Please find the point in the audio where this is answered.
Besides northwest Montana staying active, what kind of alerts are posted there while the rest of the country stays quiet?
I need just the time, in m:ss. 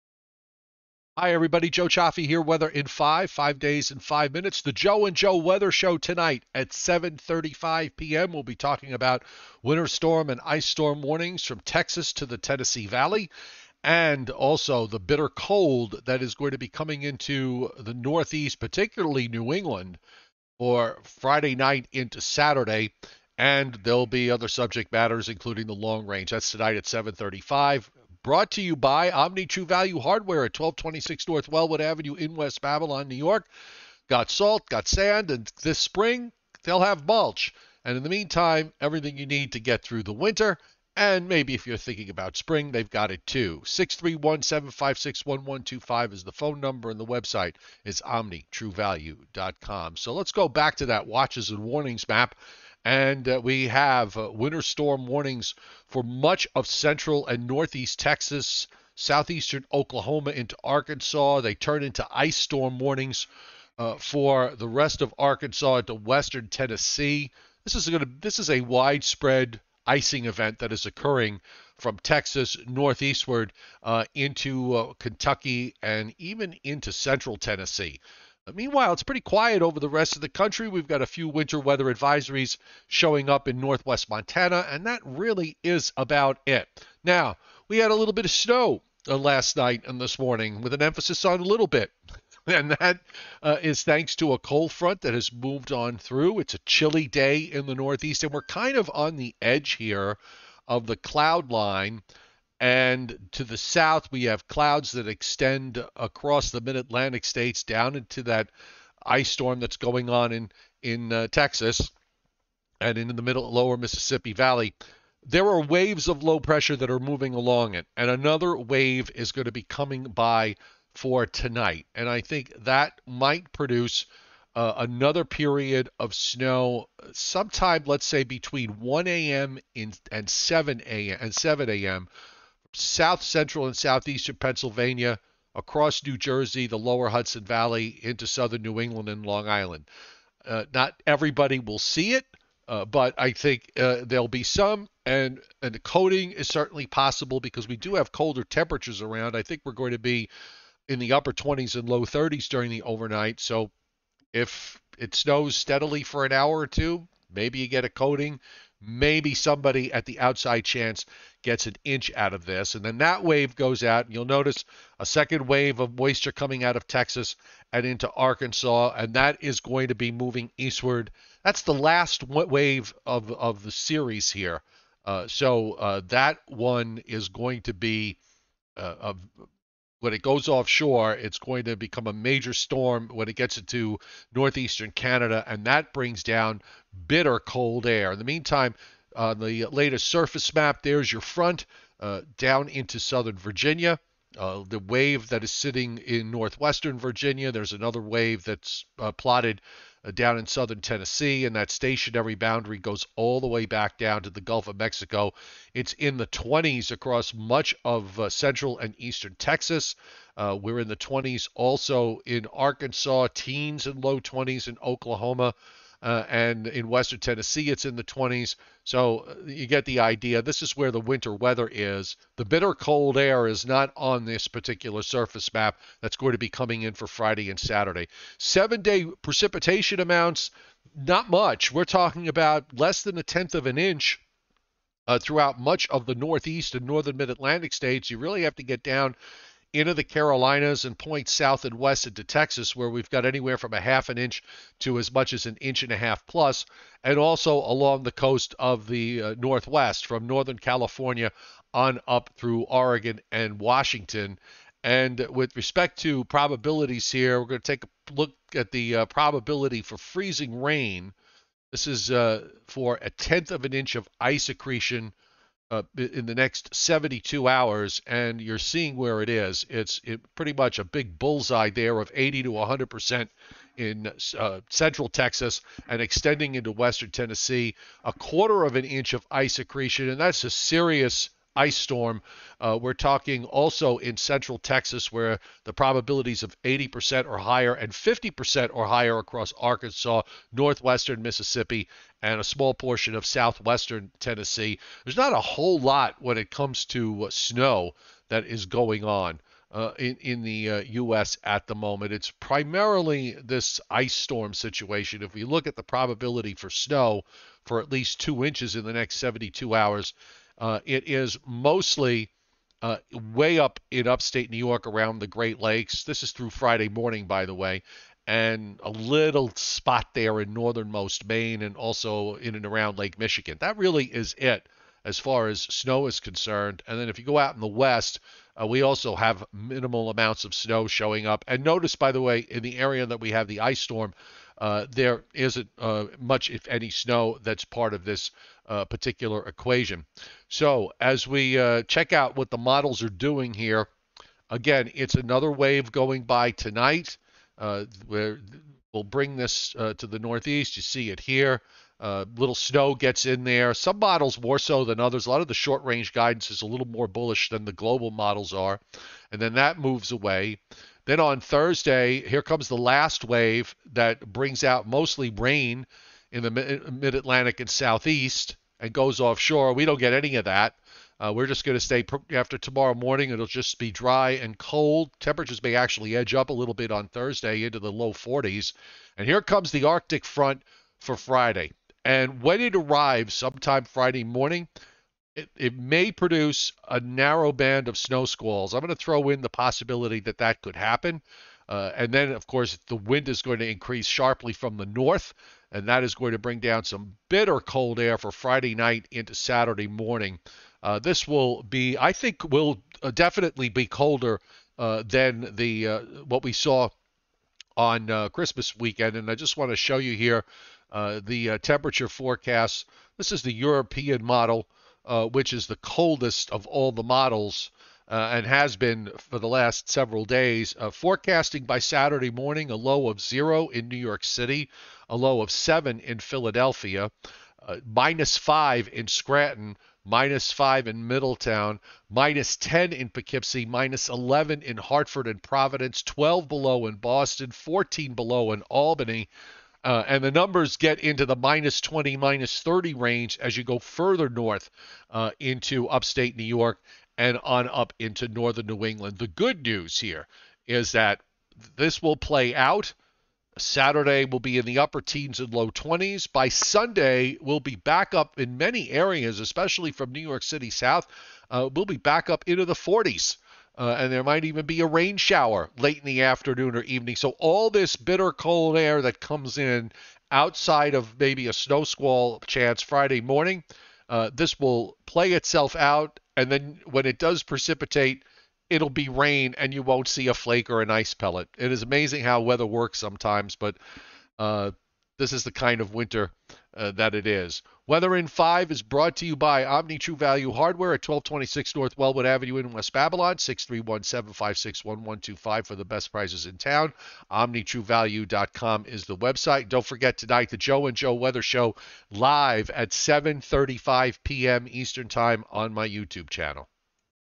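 1:21.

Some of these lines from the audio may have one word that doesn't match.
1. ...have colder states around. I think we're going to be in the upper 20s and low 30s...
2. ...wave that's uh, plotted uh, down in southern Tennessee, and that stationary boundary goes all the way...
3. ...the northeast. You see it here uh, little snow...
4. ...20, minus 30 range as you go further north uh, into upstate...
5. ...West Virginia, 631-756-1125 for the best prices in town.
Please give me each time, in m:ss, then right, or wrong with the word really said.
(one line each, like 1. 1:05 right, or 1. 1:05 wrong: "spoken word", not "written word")
1. 2:27 wrong: "temperatures", not "states"
2. 3:18 right
3. 5:50 right
4. 7:21 right
5. 8:12 wrong: "Babylon", not "Virginia".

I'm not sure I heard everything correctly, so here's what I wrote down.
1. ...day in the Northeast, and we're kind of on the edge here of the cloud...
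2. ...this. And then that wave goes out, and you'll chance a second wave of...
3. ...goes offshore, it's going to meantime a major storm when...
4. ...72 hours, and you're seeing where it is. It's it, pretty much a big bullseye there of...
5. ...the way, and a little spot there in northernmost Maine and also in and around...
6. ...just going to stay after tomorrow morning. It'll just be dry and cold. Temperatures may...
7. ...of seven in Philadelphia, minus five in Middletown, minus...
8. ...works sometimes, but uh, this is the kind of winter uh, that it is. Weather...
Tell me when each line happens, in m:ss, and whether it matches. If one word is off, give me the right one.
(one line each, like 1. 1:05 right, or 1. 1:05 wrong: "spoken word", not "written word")
1. 1:37 right
2. 2:42 wrong: "notice", not "chance"
3. 3:00 wrong: "become", not "meantime"
4. 4:26 right
5. 5:17 right
6. 6:11 right
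7. 7:05 wrong: "Scranton", not "Middletown"
8. 8:02 right.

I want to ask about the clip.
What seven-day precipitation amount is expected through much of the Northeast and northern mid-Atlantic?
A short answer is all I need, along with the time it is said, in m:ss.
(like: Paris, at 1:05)
Less than a tenth of an inch, at 3:52.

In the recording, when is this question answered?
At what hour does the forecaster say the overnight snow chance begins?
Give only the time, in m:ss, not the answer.
2:08.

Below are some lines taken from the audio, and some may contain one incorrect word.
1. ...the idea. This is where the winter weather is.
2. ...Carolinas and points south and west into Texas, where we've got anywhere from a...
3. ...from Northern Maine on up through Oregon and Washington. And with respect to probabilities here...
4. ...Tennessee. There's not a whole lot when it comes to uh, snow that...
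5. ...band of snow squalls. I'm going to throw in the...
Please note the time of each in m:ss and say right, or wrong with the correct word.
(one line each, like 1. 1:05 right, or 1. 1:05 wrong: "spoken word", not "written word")
1. 3:39 right
2. 4:00 right
3. 4:10 wrong: "California", not "Maine"
4. 4:54 right
5. 6:27 right.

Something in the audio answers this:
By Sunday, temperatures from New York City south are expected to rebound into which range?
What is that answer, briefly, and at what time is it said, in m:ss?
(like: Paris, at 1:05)
the 40s, at 7:42.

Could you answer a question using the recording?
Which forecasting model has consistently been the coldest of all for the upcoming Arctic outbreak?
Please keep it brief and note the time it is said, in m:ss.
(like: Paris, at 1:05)
European model, at 6:53.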